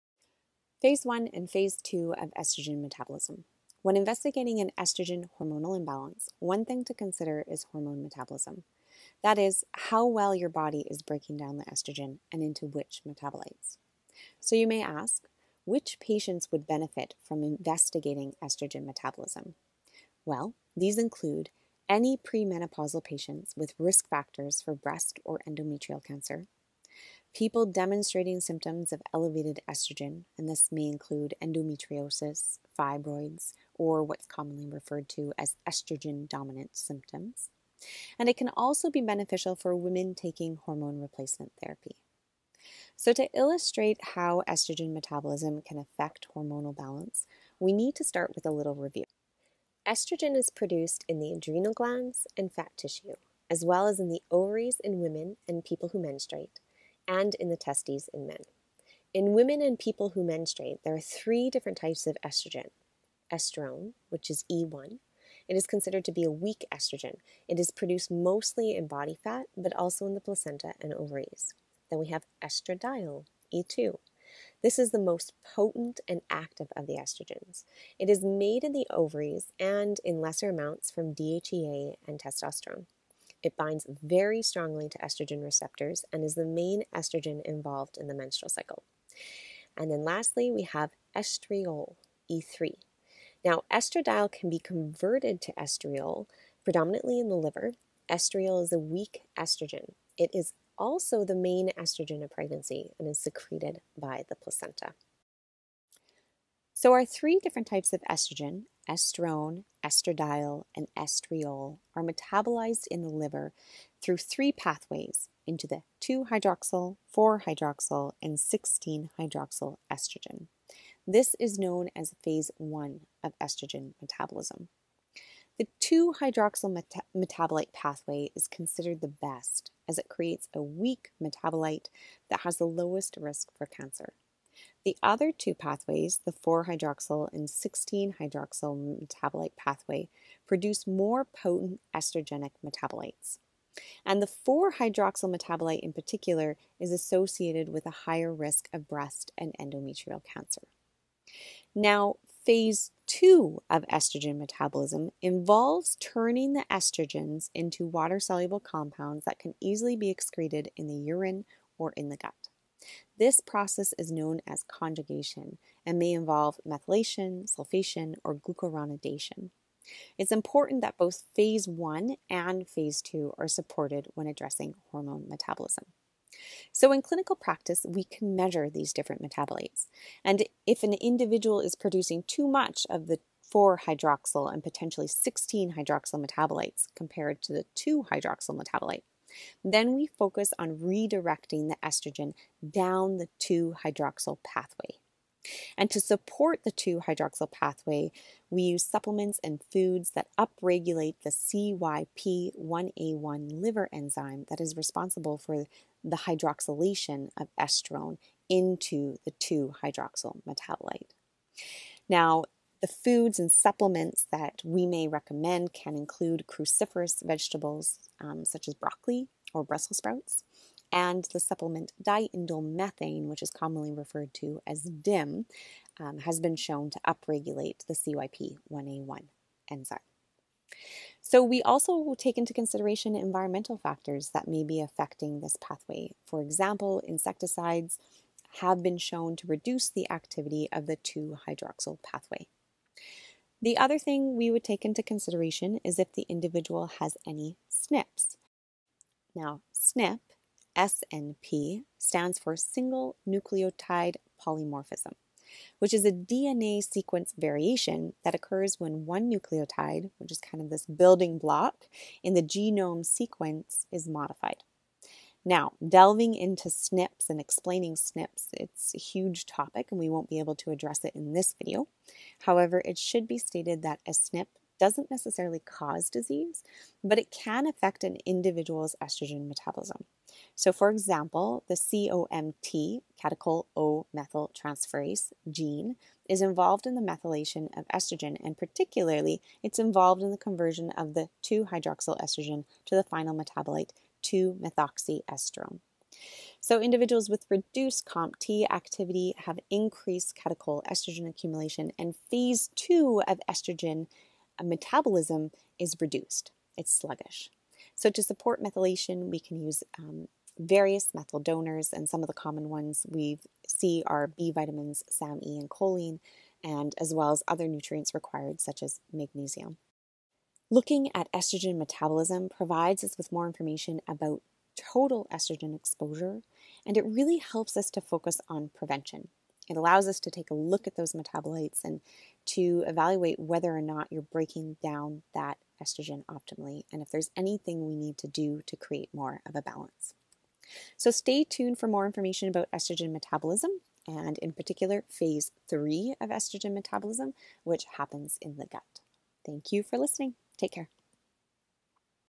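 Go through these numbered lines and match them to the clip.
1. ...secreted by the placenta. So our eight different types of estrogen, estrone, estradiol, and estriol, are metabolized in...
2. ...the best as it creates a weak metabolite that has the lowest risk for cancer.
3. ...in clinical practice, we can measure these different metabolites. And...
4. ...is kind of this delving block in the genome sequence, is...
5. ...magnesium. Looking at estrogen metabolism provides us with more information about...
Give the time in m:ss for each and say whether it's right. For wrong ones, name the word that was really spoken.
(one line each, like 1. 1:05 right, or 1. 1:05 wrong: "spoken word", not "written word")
1. 1:43 wrong: "three", not "eight"
2. 2:09 right
3. 2:56 right
4. 4:20 wrong: "building", not "delving"
5. 5:19 right.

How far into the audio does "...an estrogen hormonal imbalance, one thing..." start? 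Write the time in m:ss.
0:04.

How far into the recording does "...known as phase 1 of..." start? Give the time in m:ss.
2:01.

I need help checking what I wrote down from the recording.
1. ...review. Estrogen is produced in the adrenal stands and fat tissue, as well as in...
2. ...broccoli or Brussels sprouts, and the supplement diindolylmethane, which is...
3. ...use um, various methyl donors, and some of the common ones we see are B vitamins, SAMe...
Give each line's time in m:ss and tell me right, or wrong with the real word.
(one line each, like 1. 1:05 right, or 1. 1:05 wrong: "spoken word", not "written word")
1. 0:48 wrong: "glands", not "stands"
2. 3:38 right
3. 5:09 right.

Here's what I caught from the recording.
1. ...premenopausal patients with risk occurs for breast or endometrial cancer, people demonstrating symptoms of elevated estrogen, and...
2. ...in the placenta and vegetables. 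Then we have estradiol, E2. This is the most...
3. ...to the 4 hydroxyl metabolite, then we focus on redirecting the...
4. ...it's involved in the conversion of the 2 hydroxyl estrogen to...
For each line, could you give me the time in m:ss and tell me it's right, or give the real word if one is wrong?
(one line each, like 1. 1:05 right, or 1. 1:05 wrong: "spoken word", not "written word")
1. 0:22 wrong: "factors", not "occurs"
2. 1:10 wrong: "ovaries", not "vegetables"
3. 3:07 wrong: "2", not "4"
4. 4:49 right.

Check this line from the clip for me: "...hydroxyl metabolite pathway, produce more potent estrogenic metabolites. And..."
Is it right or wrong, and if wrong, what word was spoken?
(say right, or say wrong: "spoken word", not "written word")
right.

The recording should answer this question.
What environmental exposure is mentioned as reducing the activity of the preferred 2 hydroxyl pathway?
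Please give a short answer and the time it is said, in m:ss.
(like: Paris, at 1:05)
Insecticides, at 3:57.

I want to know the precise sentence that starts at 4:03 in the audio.
The other thing we would take into consideration is if the individual has any SNPs.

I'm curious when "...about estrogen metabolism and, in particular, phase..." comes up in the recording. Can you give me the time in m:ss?
5:42.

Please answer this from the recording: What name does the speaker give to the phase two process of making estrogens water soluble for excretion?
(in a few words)
Conjugation.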